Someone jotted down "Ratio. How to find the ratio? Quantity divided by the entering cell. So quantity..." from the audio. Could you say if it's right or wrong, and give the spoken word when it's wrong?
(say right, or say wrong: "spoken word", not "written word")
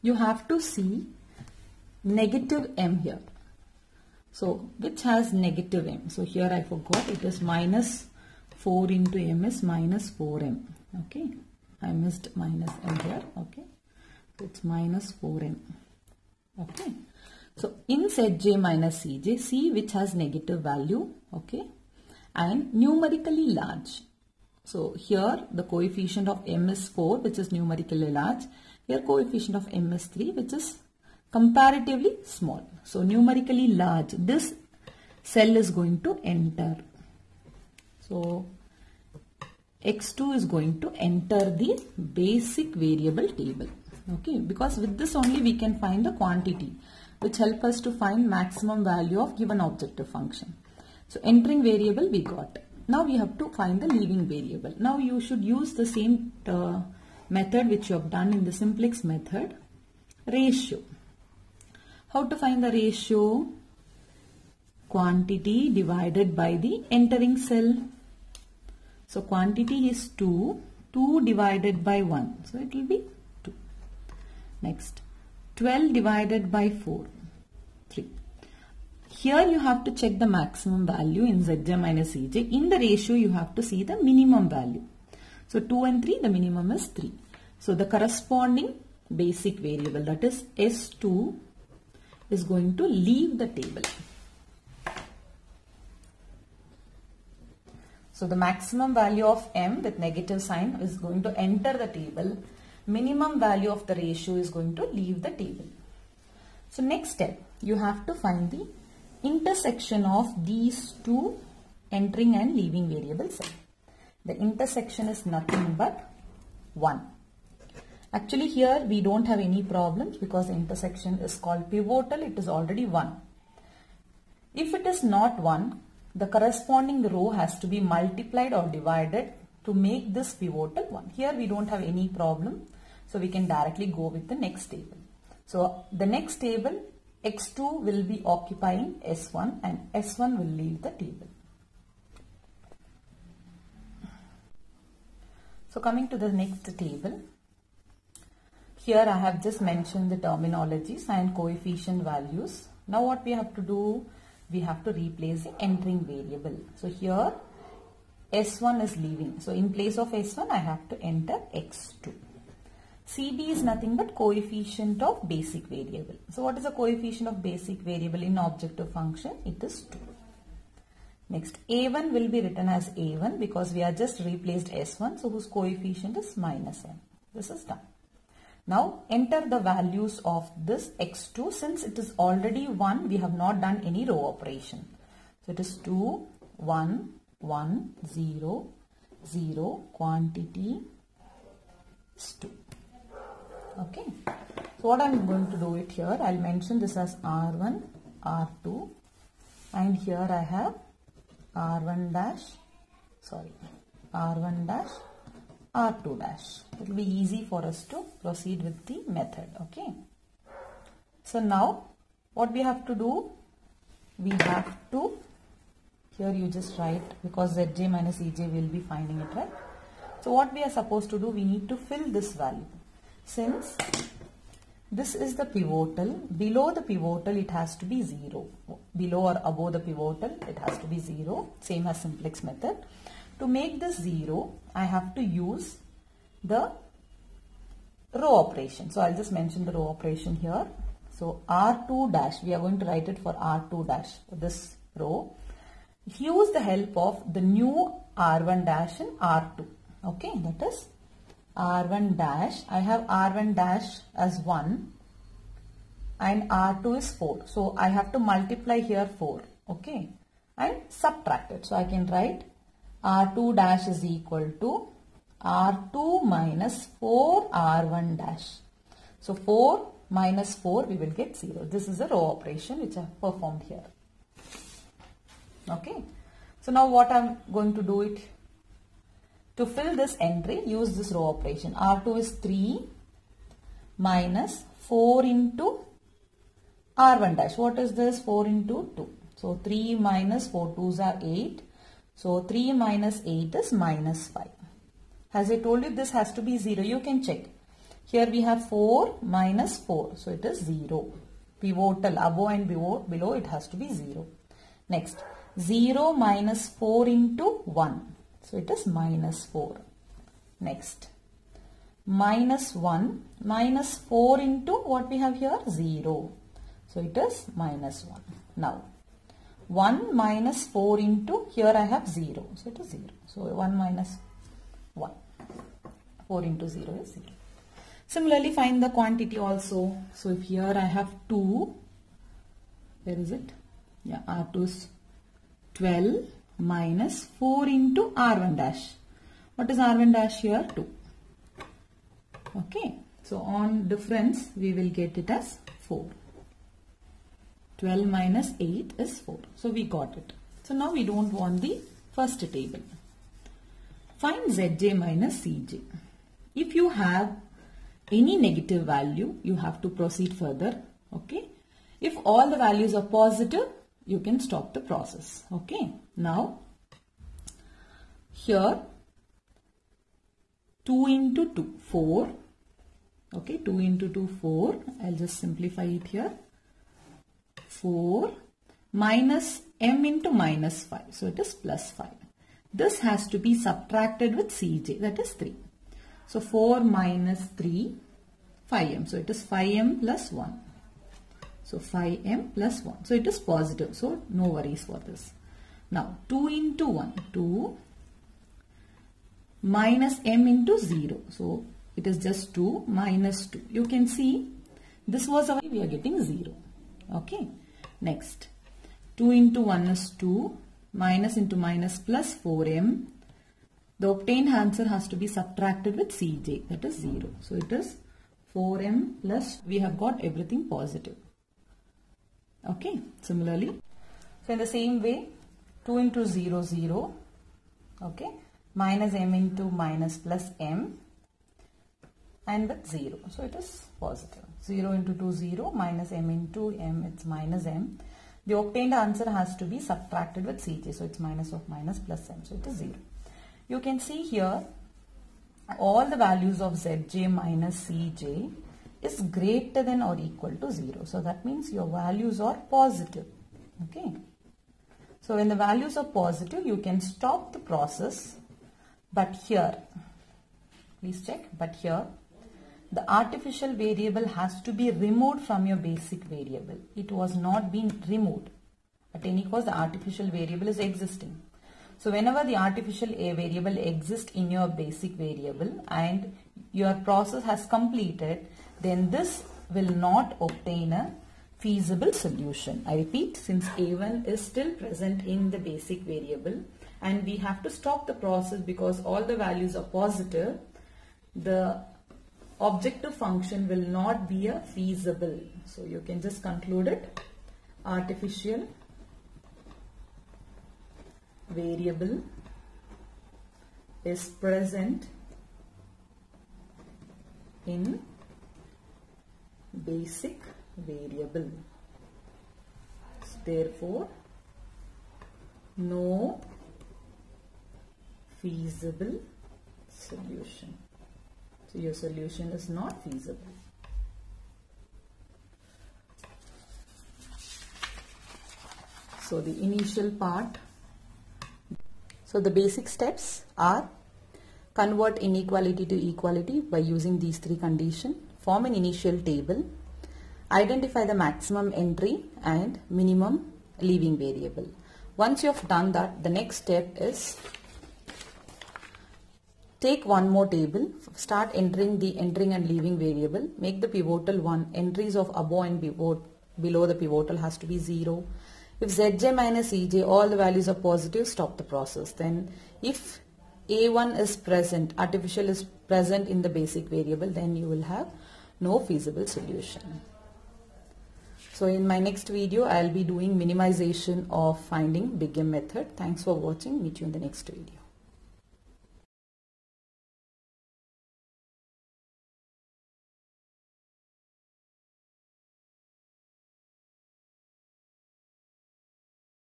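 right.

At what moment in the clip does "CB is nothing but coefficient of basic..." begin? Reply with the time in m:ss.
2:43.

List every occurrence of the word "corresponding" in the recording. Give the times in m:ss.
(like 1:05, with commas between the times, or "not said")
1:27, 2:06.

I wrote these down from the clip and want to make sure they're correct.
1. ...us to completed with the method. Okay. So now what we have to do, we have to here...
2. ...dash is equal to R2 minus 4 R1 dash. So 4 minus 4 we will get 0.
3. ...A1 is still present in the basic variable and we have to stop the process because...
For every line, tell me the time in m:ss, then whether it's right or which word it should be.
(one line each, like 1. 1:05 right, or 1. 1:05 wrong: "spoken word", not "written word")
1. 3:27 wrong: "proceed", not "completed"
2. 4:23 right
3. 8:03 right.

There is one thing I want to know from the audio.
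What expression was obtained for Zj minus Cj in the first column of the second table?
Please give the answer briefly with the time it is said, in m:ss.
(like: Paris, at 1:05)
5M + 1, at 6:29.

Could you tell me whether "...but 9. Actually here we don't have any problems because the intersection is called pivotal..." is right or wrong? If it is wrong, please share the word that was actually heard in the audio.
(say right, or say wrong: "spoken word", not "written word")
wrong: "1", not "9".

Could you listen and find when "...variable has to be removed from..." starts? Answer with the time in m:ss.
7:43.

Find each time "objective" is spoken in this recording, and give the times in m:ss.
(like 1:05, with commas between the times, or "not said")
0:49, 2:48, 8:12.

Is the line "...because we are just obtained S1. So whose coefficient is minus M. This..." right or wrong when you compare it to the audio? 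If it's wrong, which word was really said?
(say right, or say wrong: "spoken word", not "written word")
wrong: "replaced", not "obtained".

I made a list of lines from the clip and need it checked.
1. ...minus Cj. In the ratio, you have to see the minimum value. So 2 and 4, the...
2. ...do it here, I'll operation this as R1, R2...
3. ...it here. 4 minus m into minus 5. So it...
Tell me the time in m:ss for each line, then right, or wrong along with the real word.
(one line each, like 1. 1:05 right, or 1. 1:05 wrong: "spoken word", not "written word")
1. 1:21 wrong: "3", not "4"
2. 3:15 wrong: "mention", not "operation"
3. 6:15 right.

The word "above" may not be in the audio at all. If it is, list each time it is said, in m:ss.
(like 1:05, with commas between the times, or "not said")
3:49, 5:02, 9:15.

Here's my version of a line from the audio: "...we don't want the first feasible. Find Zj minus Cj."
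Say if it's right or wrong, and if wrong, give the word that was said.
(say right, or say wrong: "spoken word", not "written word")
wrong: "table", not "feasible".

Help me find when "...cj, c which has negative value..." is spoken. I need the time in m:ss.
0:19.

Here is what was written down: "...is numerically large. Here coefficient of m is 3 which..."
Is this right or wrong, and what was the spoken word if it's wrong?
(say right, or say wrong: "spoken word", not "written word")
right.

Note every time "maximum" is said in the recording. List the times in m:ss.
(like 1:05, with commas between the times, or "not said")
0:48, 1:20, 1:38, 9:01.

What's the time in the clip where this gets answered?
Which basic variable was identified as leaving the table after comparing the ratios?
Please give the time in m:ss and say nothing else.
1:30.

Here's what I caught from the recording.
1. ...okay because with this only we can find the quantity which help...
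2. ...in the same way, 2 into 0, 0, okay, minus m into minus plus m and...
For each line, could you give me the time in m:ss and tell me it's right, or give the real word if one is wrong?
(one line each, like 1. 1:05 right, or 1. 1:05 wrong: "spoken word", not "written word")
1. 0:44 right
2. 7:04 right.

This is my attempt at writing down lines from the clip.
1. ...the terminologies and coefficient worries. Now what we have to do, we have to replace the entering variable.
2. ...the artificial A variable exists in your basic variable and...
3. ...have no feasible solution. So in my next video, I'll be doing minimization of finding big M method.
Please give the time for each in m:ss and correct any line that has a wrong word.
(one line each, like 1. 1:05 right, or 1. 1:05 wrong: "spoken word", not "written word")
1. 2:30 wrong: "values", not "worries"
2. 7:52 right
3. 9:27 right.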